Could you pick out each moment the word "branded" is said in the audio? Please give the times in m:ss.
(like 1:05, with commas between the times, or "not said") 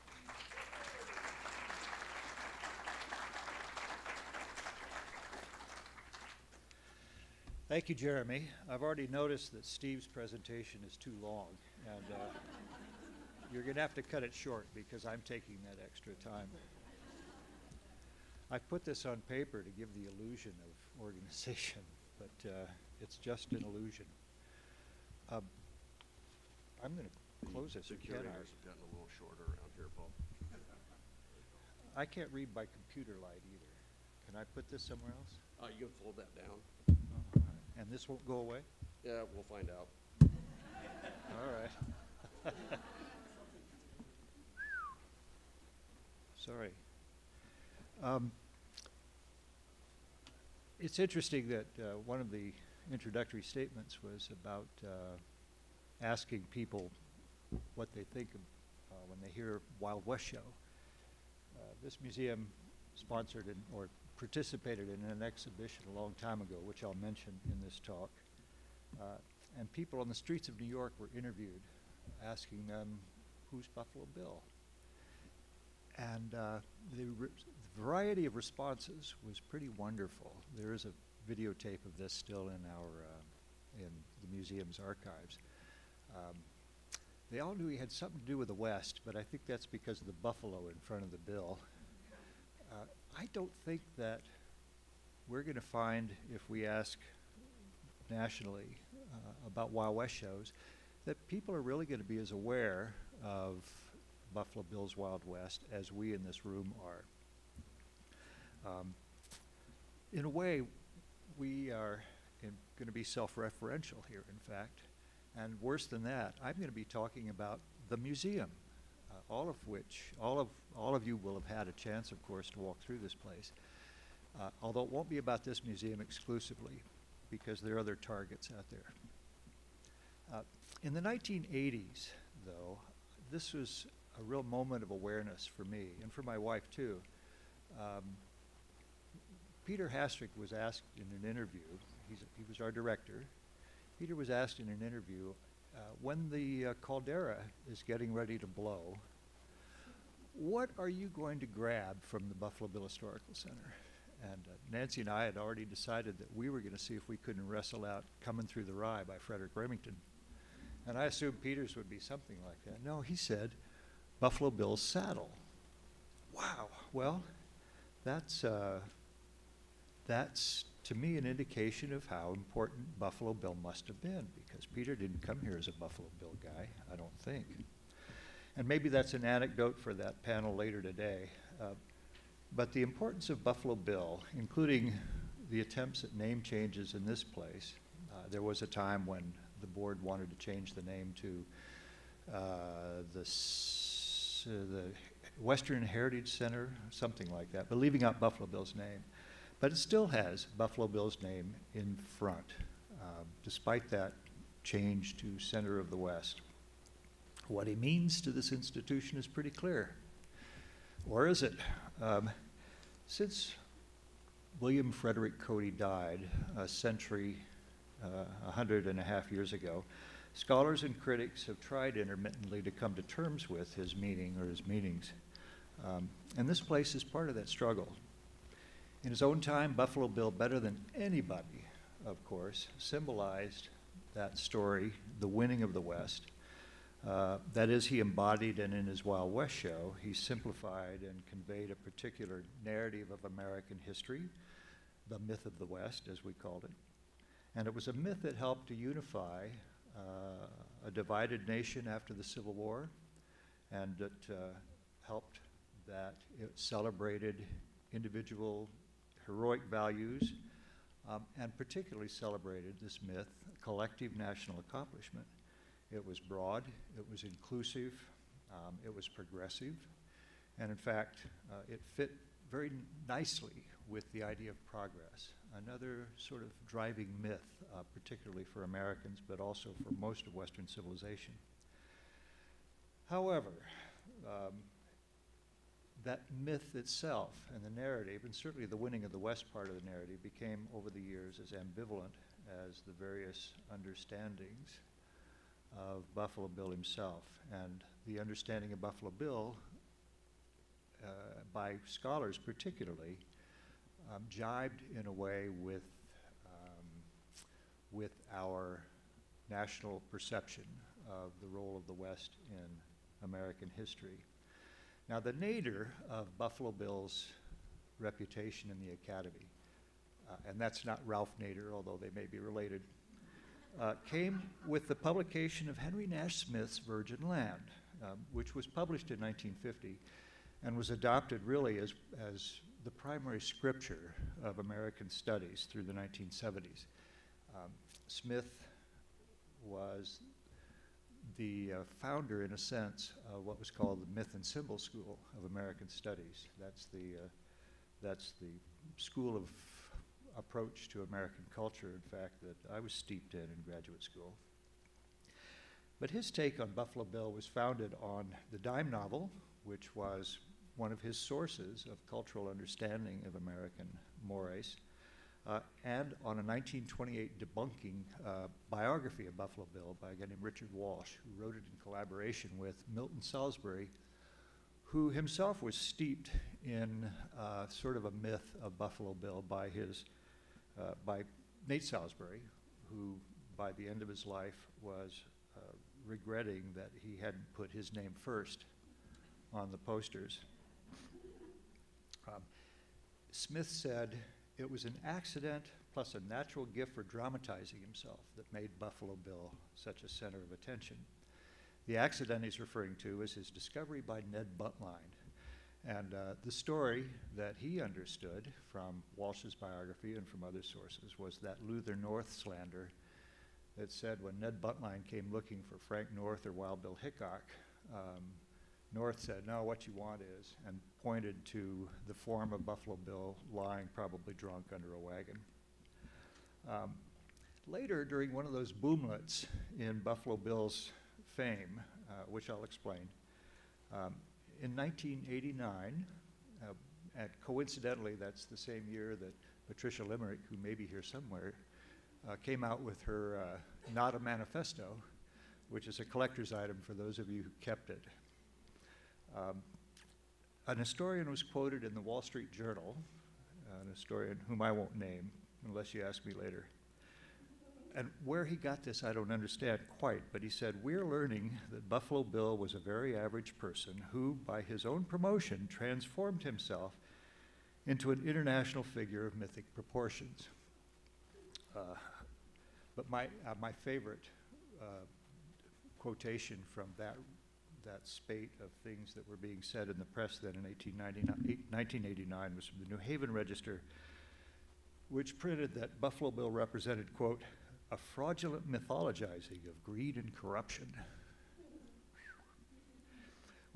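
not said.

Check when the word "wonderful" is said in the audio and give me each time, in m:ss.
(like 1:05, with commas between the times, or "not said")
1:19.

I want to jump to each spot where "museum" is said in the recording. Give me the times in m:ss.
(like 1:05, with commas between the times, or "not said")
1:01, 1:24, 1:57, 2:05.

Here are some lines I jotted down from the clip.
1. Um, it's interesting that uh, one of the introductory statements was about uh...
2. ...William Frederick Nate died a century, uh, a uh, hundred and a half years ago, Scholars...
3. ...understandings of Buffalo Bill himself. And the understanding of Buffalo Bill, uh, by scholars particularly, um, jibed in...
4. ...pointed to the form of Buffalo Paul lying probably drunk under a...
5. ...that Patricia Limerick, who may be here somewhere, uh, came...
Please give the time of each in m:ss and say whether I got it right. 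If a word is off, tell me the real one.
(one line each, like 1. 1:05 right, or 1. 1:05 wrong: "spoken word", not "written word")
1. 0:48 right
2. 3:34 wrong: "Cody", not "Nate"
3. 4:53 right
4. 7:01 wrong: "Bill", not "Paul"
5. 7:19 right.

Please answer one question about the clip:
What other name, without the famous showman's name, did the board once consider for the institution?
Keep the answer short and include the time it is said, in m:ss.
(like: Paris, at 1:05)
Western Heritage Center, at 3:15.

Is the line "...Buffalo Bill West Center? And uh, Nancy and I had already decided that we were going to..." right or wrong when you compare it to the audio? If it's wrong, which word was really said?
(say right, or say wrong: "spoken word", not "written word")
wrong: "Historical", not "West".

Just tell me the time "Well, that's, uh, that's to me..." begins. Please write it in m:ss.
2:46.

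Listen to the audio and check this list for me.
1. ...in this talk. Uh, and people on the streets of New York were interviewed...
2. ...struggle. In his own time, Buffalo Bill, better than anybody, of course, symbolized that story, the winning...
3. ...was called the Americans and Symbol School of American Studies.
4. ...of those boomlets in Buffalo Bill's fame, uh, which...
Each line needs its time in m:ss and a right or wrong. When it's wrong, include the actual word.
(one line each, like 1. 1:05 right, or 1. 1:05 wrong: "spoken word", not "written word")
1. 1:07 right
2. 3:47 right
3. 5:43 wrong: "Myth", not "Americans"
4. 7:08 right.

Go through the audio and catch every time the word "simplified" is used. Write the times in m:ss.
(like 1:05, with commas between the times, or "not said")
4:00.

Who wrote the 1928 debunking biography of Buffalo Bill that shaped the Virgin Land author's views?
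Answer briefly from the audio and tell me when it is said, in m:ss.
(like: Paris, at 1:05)
Richard Walsh, at 6:10.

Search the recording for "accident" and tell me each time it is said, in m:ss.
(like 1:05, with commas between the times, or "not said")
6:35, 6:41.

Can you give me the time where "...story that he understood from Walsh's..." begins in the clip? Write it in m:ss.
6:46.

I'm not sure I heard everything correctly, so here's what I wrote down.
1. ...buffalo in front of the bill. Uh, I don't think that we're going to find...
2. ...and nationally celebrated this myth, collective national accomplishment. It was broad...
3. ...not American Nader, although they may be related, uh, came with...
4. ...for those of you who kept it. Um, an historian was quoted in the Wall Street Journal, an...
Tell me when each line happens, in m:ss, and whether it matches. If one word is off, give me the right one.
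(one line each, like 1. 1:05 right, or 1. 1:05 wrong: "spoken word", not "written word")
1. 1:30 right
2. 4:21 wrong: "particularly", not "nationally"
3. 5:20 wrong: "Ralph", not "American"
4. 7:26 right.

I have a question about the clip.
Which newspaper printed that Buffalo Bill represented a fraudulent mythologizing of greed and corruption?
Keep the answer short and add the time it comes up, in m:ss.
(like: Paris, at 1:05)
New Haven Register, at 8:02.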